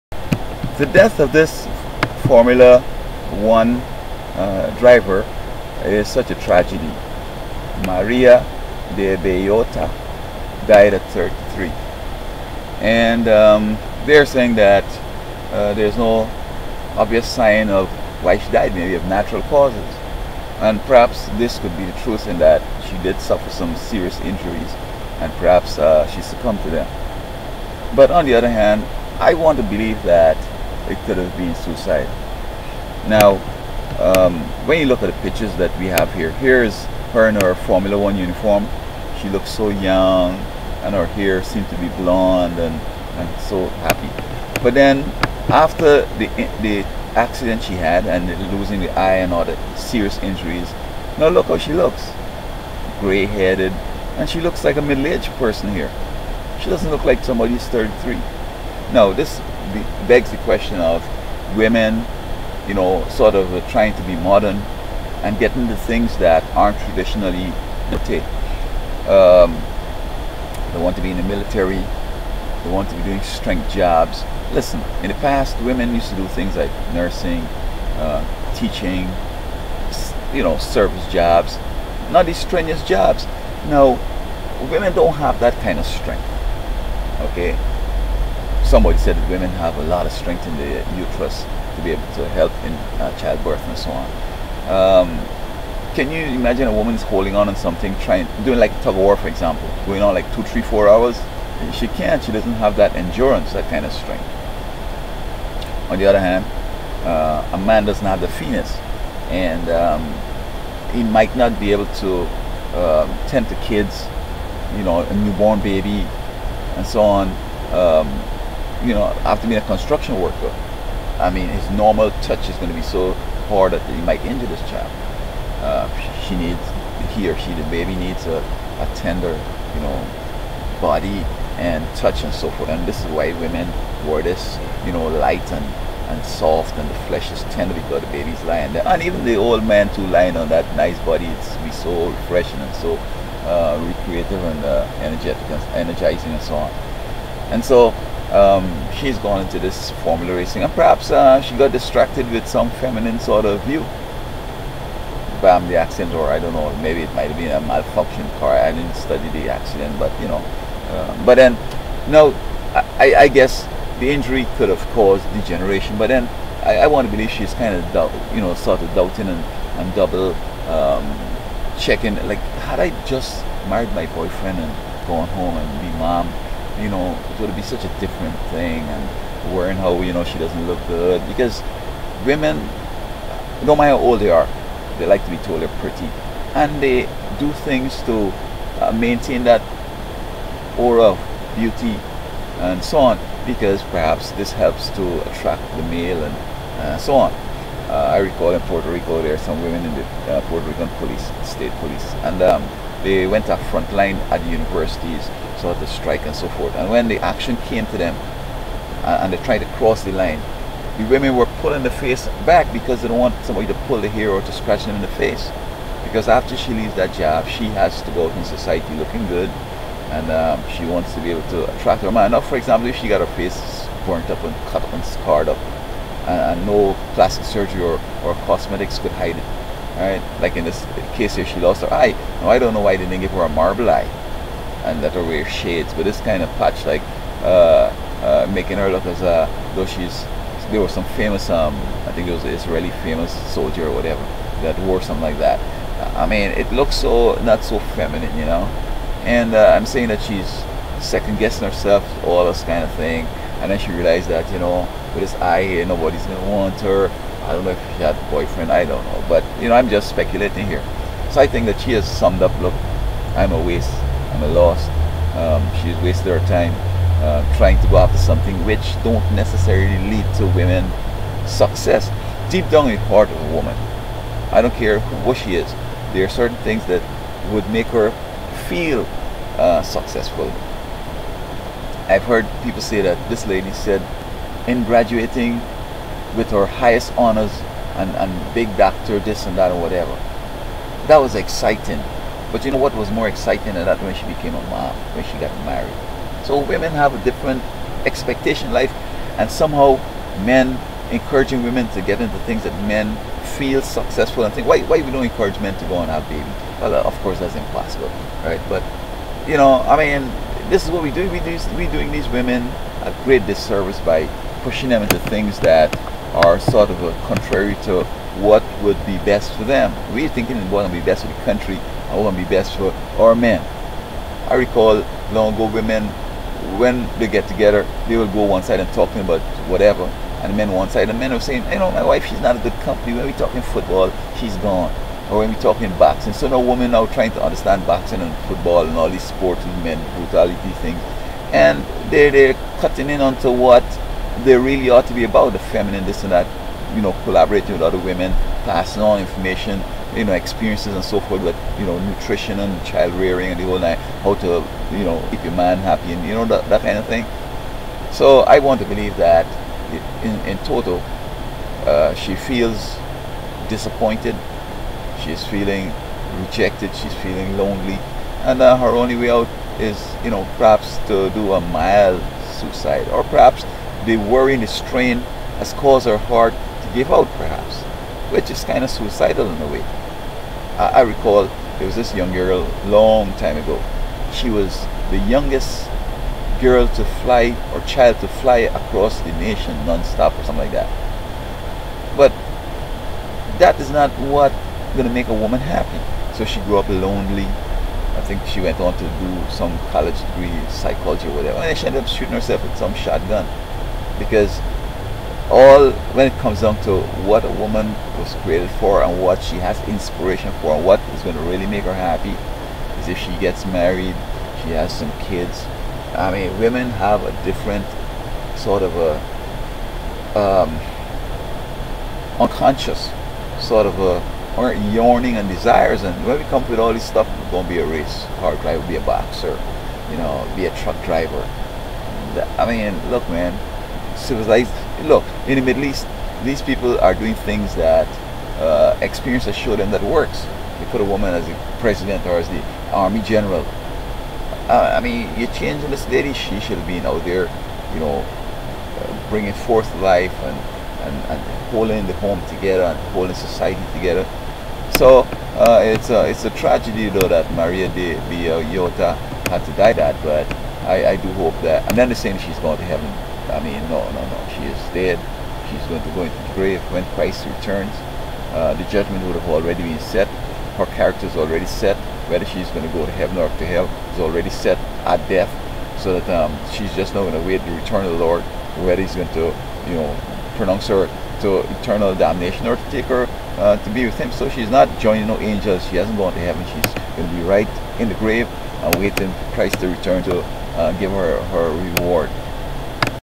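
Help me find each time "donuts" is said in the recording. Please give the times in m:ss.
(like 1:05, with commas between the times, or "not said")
not said.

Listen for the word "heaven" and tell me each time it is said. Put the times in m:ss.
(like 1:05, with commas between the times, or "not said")
7:42, 7:53, 8:06.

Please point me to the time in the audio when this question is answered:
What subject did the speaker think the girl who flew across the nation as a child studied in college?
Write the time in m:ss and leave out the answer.
6:40.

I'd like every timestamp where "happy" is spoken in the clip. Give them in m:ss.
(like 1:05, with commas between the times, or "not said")
0:43, 5:55, 6:35, 6:51.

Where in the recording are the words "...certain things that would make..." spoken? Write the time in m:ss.
4:36.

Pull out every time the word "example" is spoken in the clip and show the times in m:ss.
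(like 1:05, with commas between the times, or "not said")
1:39, 3:42.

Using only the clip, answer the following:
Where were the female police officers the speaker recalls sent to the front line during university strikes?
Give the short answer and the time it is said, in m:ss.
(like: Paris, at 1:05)
Puerto Rico, at 3:18.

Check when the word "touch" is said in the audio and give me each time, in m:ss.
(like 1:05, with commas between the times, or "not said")
2:02, 2:11.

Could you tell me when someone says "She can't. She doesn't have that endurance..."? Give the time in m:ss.
1:41.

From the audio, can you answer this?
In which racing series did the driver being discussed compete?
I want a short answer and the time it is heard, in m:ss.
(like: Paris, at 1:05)
Formula 1, at 0:02.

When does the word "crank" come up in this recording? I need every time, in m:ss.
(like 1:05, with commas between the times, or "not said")
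not said.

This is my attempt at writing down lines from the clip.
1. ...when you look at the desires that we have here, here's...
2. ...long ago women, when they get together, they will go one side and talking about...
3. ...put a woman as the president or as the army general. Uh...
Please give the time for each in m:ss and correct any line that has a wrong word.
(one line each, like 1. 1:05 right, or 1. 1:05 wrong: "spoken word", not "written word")
1. 0:34 wrong: "pictures", not "desires"
2. 5:25 right
3. 7:20 right.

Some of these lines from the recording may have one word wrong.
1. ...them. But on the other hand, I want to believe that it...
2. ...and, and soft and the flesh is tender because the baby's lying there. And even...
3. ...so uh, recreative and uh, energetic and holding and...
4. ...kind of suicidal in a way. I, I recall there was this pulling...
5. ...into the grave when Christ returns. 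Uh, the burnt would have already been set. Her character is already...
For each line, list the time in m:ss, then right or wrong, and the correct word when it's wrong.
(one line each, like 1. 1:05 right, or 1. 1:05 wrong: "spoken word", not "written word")
1. 0:26 right
2. 2:15 right
3. 2:22 wrong: "energizing", not "holding"
4. 6:18 wrong: "young", not "pulling"
5. 7:46 wrong: "judgment", not "burnt".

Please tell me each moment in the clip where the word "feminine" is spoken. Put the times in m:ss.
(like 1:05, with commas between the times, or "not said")
2:32, 4:07, 5:45.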